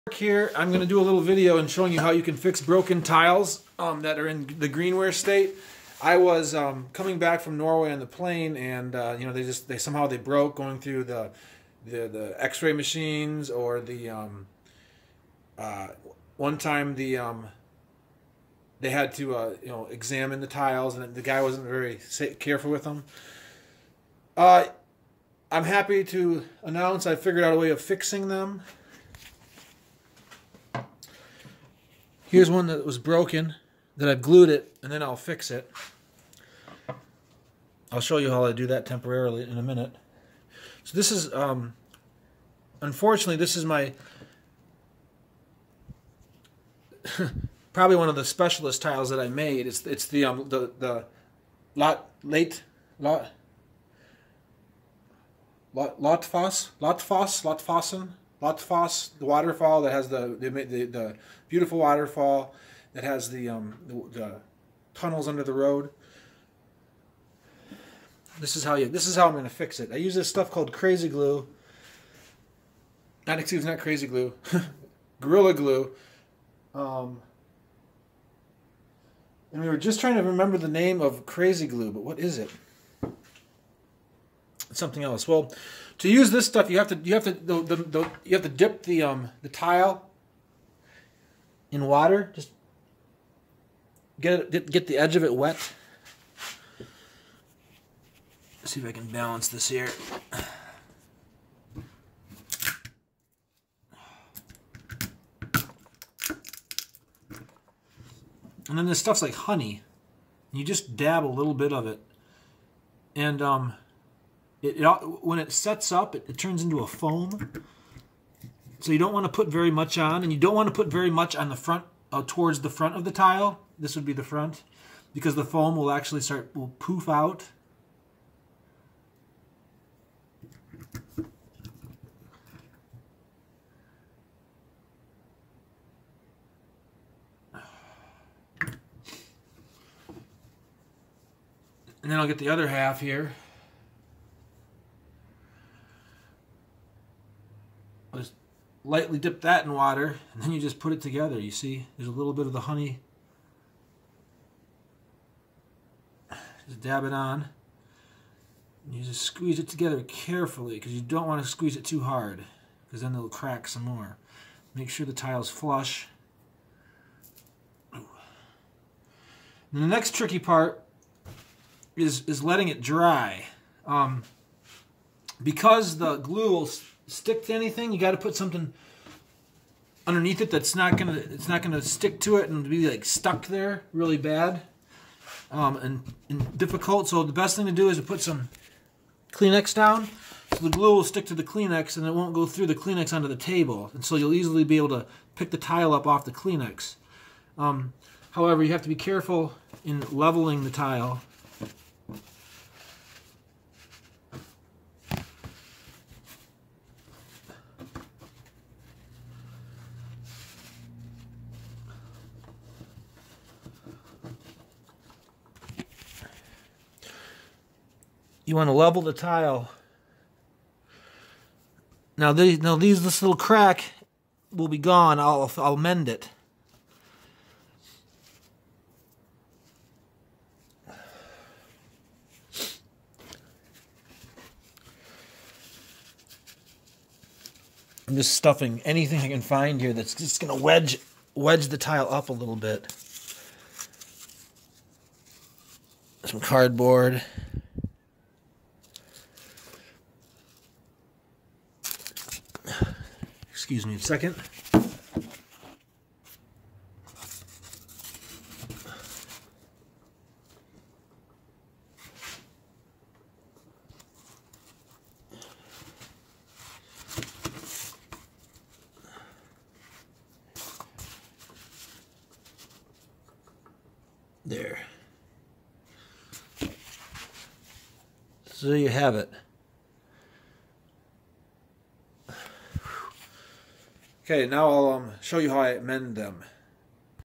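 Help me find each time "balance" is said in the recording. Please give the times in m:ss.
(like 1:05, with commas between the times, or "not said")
1:39.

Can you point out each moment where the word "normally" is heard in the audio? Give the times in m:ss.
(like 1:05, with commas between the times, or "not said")
not said.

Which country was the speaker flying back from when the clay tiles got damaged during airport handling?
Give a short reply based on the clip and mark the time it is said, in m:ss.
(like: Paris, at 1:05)
Norway, at 0:07.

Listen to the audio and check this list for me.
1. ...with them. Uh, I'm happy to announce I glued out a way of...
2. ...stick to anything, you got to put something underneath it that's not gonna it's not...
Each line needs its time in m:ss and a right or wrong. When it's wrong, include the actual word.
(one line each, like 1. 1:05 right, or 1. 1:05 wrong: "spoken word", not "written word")
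1. 0:22 wrong: "figured", not "glued"
2. 2:57 right.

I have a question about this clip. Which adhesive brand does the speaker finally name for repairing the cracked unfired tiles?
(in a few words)
Gorilla Glue.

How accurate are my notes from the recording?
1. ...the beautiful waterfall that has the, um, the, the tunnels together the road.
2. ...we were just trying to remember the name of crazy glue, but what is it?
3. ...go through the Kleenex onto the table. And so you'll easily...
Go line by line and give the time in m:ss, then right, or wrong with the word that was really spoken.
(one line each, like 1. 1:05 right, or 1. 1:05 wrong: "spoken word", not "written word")
1. 1:00 wrong: "under", not "together"
2. 1:19 right
3. 3:12 right.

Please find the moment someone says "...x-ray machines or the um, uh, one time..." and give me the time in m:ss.
0:12.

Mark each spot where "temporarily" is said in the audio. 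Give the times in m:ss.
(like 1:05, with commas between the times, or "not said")
0:38.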